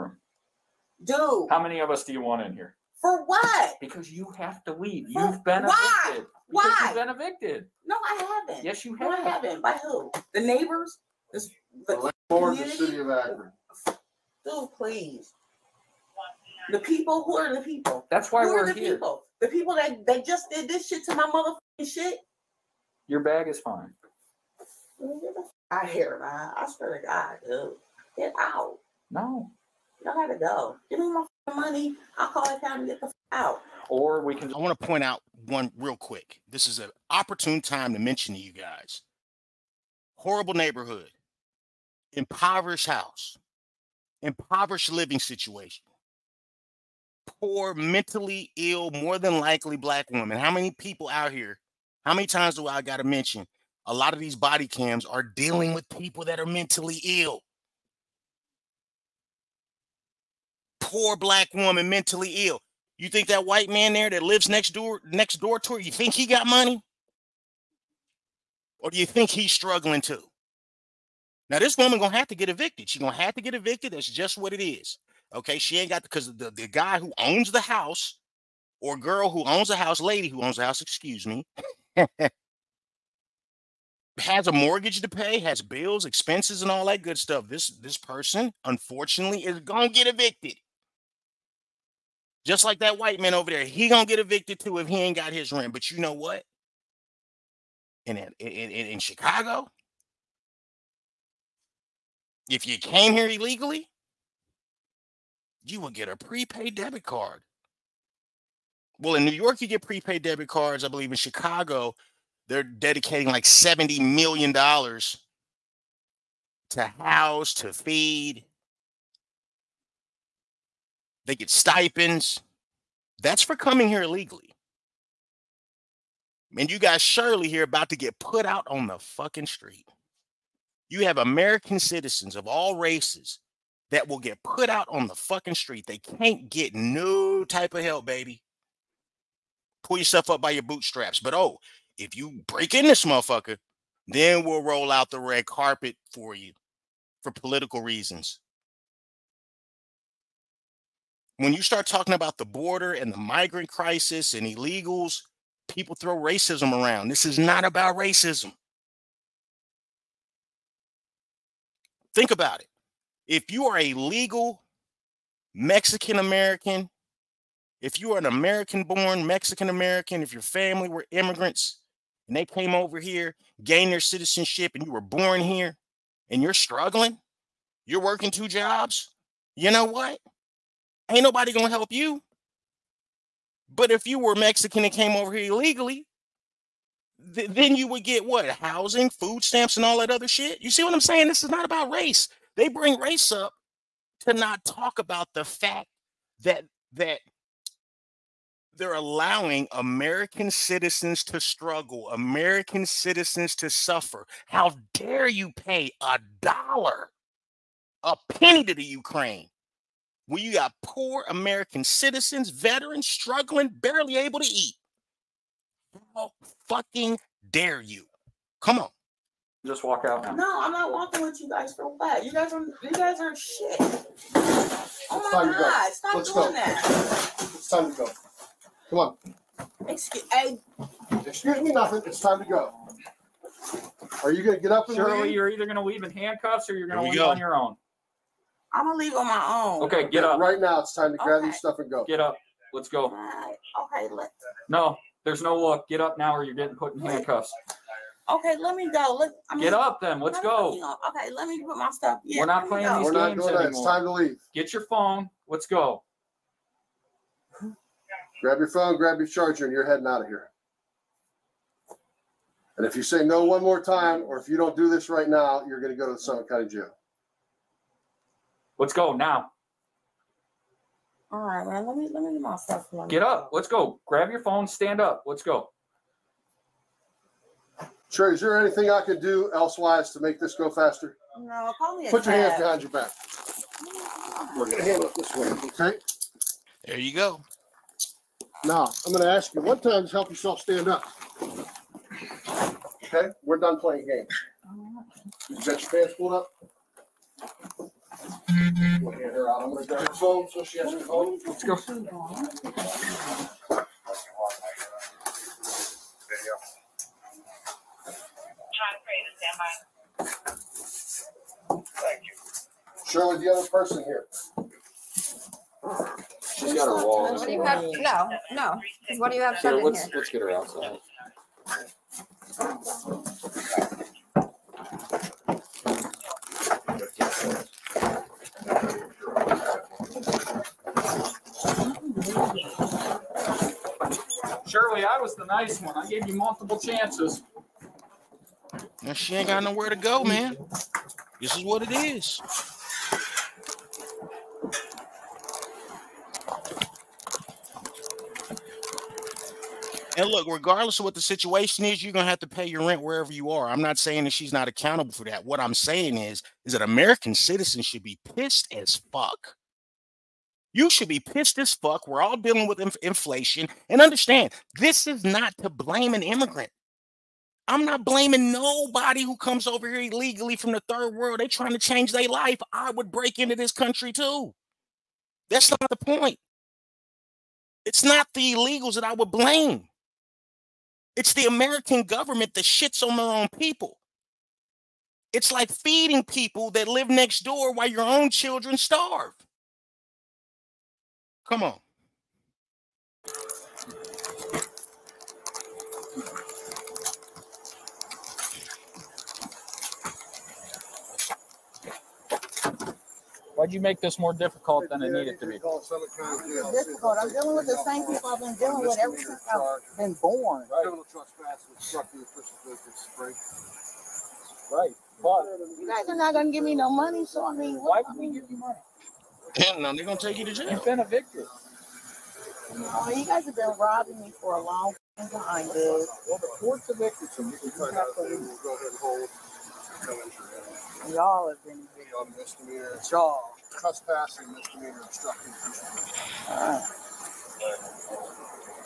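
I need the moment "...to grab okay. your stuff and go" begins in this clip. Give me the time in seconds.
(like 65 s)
241 s.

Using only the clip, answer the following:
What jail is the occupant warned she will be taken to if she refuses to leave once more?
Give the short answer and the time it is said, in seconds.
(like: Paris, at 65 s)
Summit County Jail, at 266 s.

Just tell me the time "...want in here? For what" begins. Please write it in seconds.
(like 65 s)
2 s.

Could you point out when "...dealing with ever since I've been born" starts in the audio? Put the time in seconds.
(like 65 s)
408 s.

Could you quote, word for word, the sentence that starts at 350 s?
And look, regardless of what the situation is, you're gonna have to pay your rent wherever you are.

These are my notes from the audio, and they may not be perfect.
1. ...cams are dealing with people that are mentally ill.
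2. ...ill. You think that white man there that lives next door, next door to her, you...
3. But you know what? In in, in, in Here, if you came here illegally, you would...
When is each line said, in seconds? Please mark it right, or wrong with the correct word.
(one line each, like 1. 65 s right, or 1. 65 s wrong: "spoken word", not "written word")
1. 54 s right
2. 62 s right
3. 95 s wrong: "Chicago", not "Here".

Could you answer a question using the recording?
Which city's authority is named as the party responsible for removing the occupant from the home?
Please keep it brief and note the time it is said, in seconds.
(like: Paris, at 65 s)
Akron, at 12 s.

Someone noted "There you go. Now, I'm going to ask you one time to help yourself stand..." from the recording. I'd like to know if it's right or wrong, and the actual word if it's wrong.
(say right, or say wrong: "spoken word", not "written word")
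right.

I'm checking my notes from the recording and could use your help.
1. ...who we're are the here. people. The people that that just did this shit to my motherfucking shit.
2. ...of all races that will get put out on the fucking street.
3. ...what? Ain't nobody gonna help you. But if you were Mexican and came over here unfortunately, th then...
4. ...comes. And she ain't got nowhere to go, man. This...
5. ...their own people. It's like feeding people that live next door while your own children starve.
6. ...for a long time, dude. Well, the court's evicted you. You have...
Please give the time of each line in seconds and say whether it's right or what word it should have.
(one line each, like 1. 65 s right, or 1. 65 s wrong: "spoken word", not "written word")
1. 18 s right
2. 132 s right
3. 179 s wrong: "illegally", not "unfortunately"
4. 336 s wrong: "chances", not "comes"
5. 383 s right
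6. 424 s right.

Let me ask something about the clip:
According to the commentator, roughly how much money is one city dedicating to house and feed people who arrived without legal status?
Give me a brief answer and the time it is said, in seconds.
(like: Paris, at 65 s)
$70 million, at 113 s.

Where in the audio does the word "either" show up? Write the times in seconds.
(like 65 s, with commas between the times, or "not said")
235 s.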